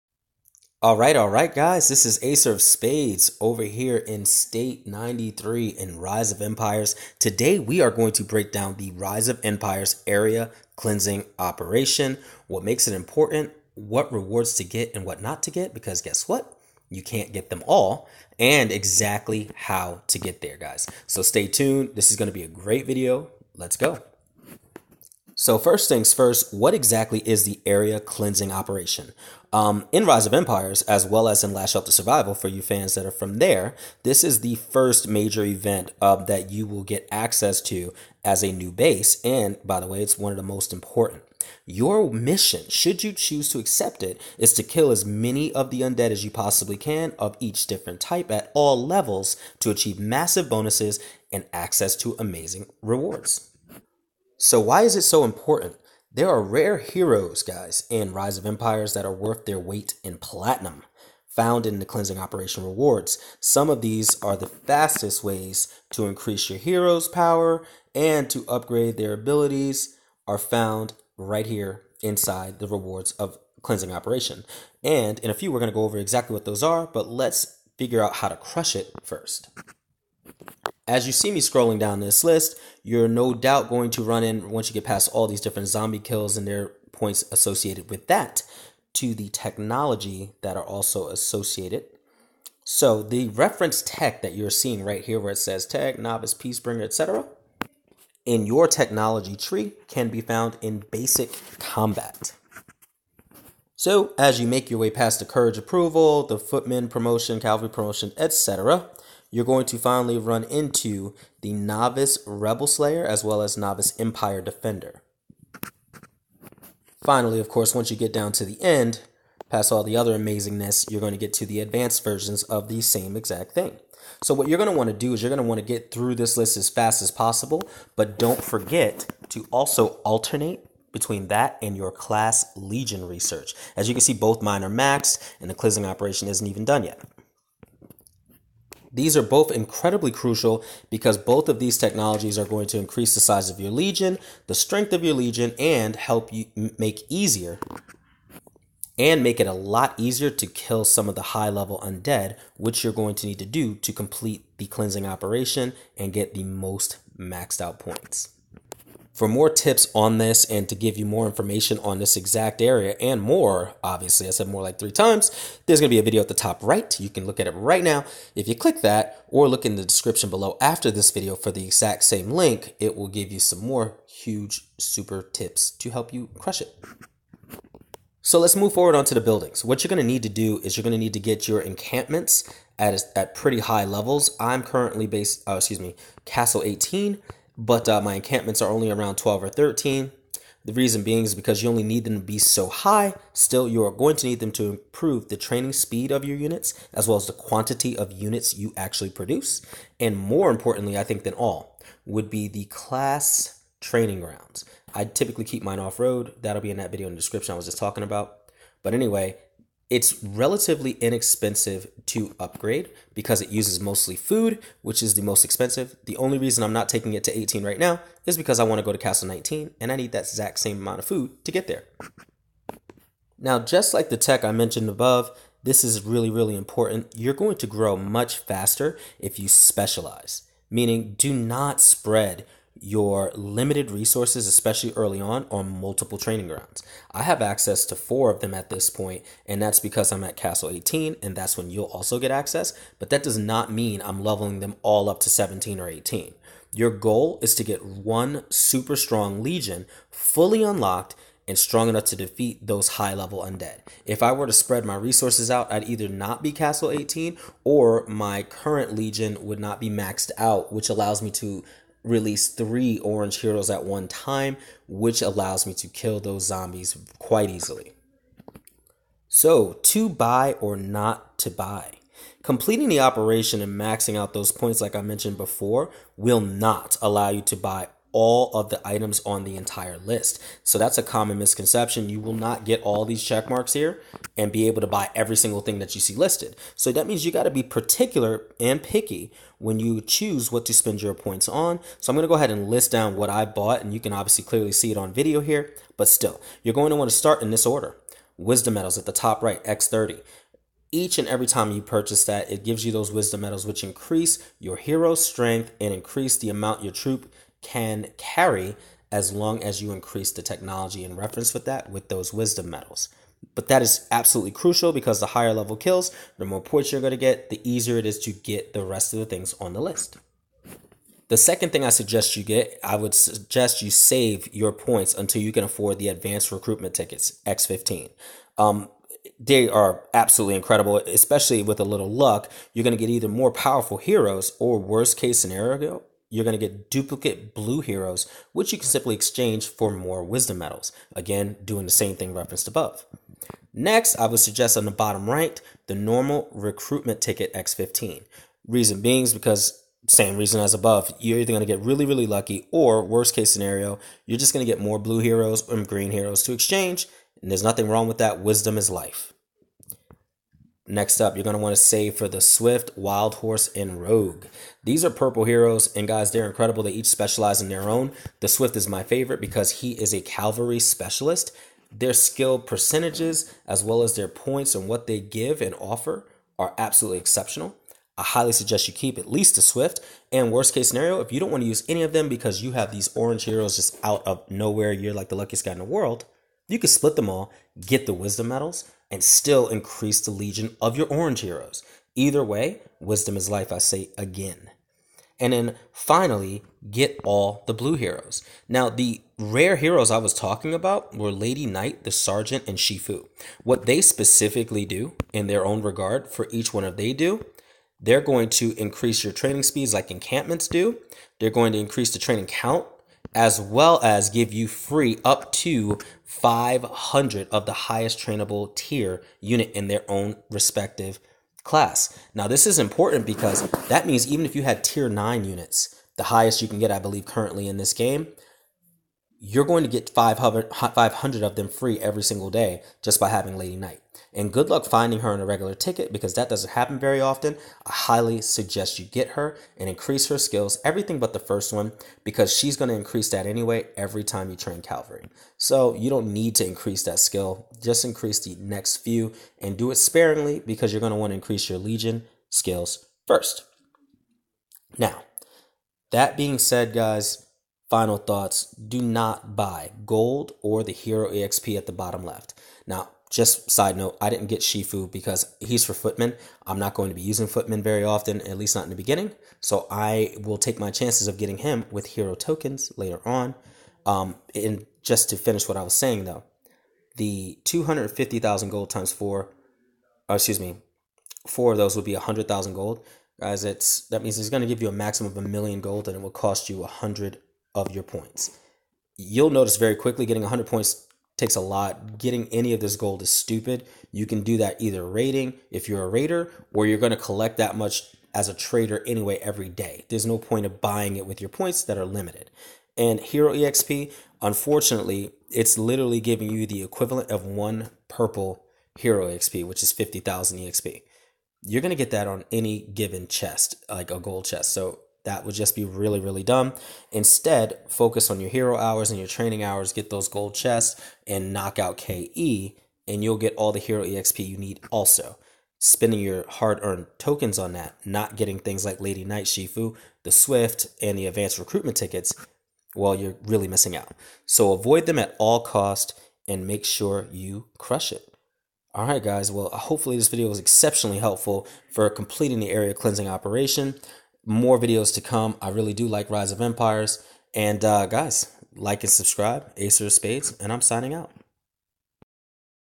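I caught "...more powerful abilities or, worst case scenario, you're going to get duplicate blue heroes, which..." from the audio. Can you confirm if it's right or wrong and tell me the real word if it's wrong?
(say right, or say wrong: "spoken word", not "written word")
wrong: "heroes", not "abilities".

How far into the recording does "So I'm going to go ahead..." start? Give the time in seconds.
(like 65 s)
291 s.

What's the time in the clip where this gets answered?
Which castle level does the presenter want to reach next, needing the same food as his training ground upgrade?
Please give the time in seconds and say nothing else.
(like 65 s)
218 s.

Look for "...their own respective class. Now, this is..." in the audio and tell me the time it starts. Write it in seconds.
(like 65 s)
419 s.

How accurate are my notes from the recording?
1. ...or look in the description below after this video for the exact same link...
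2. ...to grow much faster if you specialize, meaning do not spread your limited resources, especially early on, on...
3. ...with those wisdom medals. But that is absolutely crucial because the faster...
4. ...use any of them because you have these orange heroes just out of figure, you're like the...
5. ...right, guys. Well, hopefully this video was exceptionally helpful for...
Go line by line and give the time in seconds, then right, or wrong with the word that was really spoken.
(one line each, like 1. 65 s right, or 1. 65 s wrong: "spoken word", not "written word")
1. 169 s right
2. 227 s right
3. 311 s wrong: "higher", not "faster"
4. 381 s wrong: "nowhere", not "figure"
5. 539 s right.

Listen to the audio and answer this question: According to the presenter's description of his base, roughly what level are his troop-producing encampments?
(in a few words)
12 or 13.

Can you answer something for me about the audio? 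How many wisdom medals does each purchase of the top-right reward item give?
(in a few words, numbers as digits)
30.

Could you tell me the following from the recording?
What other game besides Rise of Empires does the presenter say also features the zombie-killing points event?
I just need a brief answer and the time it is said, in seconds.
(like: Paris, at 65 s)
Last Shelter: Survival, at 31 s.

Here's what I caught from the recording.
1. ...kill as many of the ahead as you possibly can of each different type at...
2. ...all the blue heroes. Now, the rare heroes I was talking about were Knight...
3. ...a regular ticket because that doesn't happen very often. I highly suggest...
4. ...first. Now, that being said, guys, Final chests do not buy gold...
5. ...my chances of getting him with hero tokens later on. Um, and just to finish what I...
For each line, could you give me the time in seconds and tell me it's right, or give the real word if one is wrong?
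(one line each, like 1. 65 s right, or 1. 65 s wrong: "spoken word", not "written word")
1. 44 s wrong: "undead", not "ahead"
2. 397 s wrong: "Lady", not "Knight"
3. 435 s right
4. 453 s wrong: "thoughts", not "chests"
5. 470 s right.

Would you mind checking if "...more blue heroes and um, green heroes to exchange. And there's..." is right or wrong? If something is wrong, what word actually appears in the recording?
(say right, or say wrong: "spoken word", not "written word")
right.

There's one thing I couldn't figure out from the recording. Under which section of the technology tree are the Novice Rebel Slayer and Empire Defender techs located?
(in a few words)
Basic combat.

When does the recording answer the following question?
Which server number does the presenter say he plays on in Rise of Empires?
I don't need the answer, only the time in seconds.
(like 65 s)
4 s.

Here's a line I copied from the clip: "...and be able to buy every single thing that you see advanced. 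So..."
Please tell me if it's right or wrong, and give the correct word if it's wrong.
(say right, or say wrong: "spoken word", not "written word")
wrong: "listed", not "advanced".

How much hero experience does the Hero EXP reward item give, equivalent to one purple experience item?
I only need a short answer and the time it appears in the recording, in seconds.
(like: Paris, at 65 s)
50,000, at 509 s.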